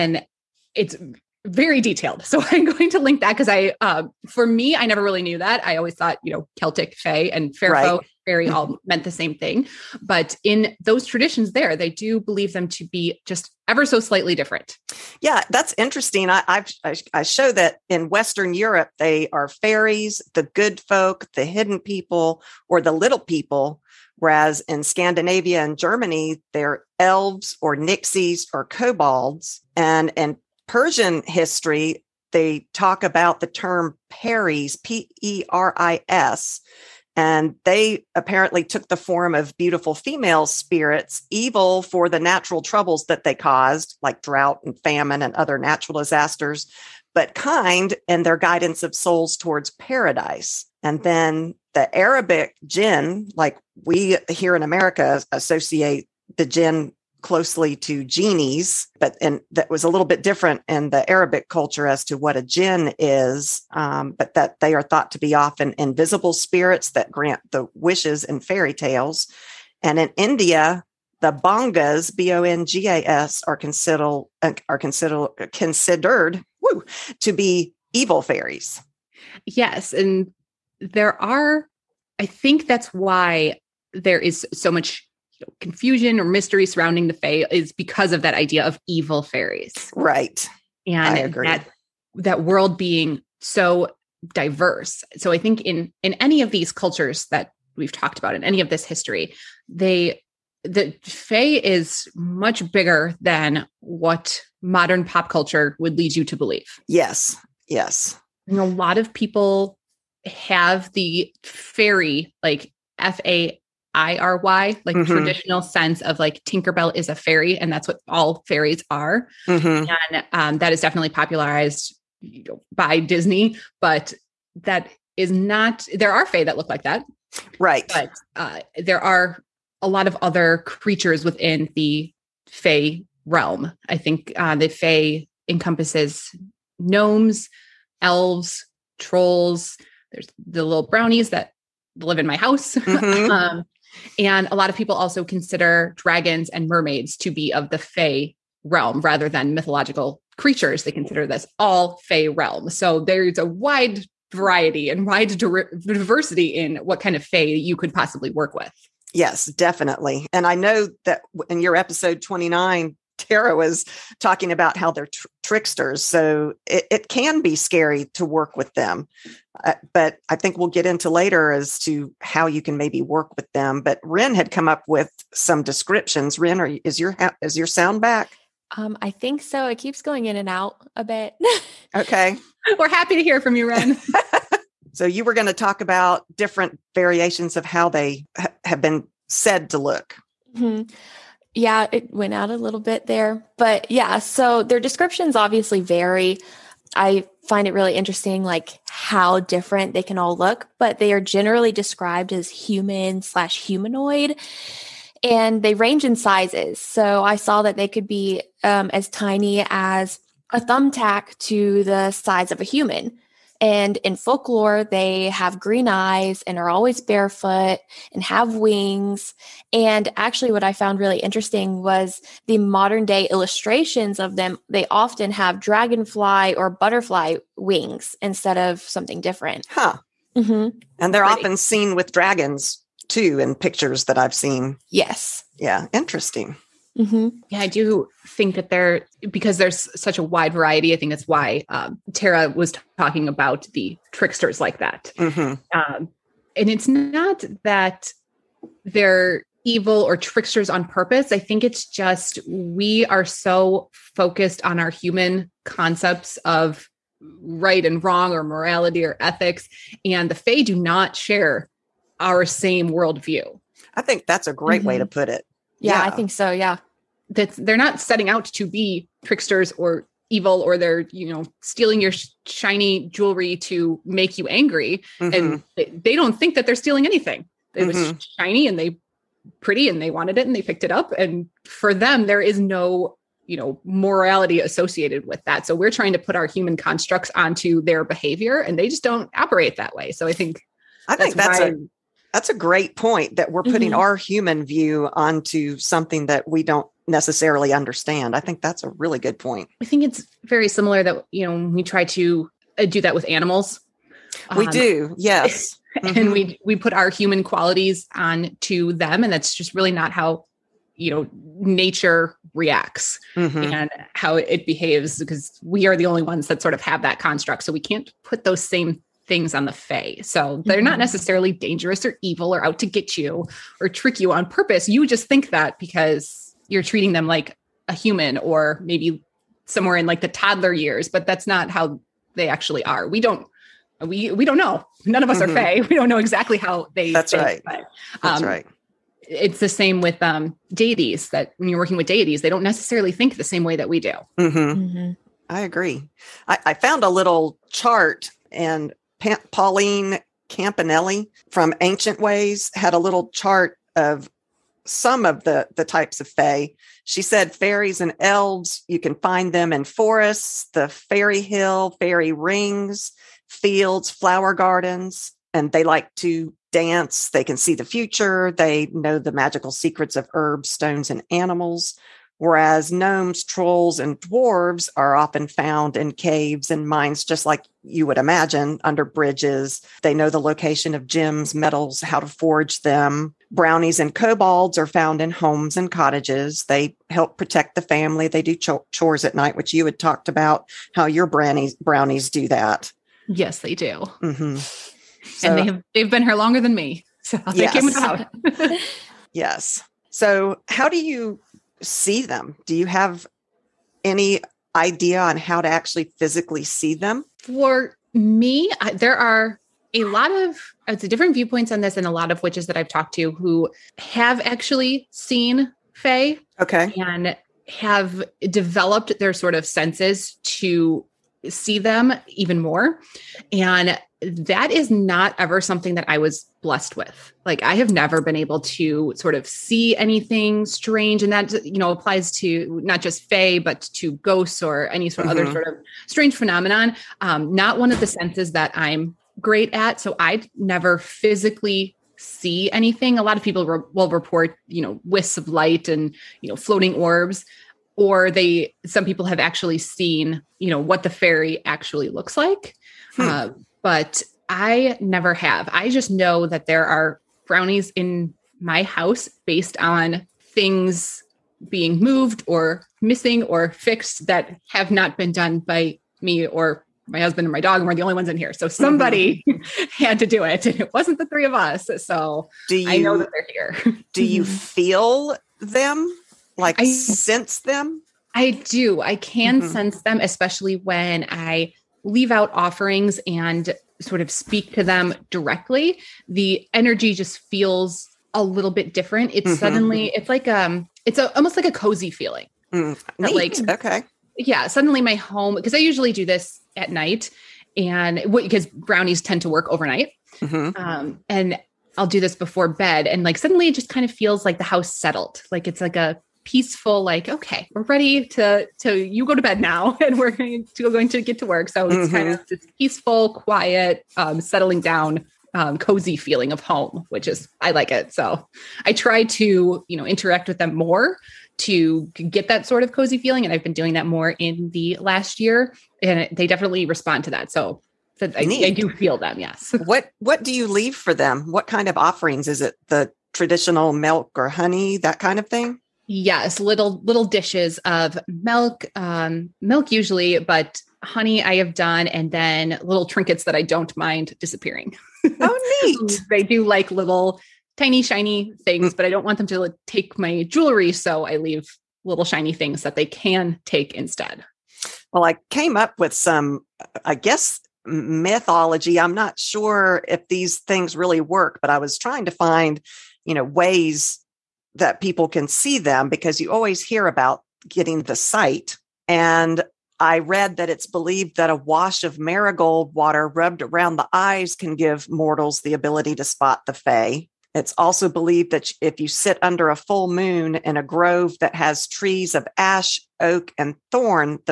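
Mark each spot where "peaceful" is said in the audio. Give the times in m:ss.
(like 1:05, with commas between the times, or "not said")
8:26, 8:32.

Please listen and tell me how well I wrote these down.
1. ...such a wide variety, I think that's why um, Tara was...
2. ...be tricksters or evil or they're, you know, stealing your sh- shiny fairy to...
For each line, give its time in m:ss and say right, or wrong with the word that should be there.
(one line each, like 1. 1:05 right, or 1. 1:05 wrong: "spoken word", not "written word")
1. 3:59 right
2. 4:28 wrong: "jewelry", not "fairy".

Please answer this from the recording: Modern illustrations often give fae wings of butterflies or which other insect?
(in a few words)
dragonfly.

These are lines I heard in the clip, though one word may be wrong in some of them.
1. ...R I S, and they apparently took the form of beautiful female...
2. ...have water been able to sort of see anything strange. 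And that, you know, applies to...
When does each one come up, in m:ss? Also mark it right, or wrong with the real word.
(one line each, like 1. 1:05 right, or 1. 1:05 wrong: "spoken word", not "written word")
1. 0:35 right
2. 7:07 wrong: "never", not "water".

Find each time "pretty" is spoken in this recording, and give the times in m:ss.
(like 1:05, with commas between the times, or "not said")
3:51, 4:39.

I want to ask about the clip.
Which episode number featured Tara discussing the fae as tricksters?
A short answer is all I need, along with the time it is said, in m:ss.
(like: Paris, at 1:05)
29, at 2:41.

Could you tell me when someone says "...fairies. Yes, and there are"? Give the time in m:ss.
1:18.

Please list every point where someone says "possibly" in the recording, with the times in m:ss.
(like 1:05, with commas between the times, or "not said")
2:37.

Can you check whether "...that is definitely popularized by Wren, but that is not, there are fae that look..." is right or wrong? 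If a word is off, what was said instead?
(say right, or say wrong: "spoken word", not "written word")
wrong: "Disney", not "Wren".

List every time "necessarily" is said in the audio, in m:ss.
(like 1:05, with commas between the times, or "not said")
4:57, 5:20, 5:42.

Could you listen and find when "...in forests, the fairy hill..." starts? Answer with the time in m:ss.
5:59.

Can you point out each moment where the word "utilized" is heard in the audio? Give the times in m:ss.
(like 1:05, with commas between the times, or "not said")
not said.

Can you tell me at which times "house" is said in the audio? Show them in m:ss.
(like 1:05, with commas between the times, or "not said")
2:22, 7:38, 8:24.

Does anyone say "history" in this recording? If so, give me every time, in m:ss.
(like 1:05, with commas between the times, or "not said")
0:31, 1:38.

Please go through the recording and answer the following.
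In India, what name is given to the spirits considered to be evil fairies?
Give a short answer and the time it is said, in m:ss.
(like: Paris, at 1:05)
bongas, at 1:11.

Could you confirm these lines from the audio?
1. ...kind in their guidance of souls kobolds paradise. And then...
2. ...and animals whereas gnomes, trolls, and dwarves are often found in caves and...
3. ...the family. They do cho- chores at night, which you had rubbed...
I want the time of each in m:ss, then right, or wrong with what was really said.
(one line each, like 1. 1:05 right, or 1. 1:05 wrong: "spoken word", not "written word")
1. 0:47 wrong: "towards", not "kobolds"
2. 6:11 right
3. 6:27 wrong: "talked", not "rubbed".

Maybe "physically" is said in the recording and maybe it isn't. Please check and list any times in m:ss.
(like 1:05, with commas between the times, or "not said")
6:46, 7:20.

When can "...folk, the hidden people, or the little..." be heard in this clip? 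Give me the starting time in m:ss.
0:20.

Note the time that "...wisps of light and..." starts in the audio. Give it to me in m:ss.
7:25.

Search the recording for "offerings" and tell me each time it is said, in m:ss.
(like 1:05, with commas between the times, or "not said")
8:02, 8:51.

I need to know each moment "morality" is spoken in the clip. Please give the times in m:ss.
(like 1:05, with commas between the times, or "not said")
4:18, 4:43.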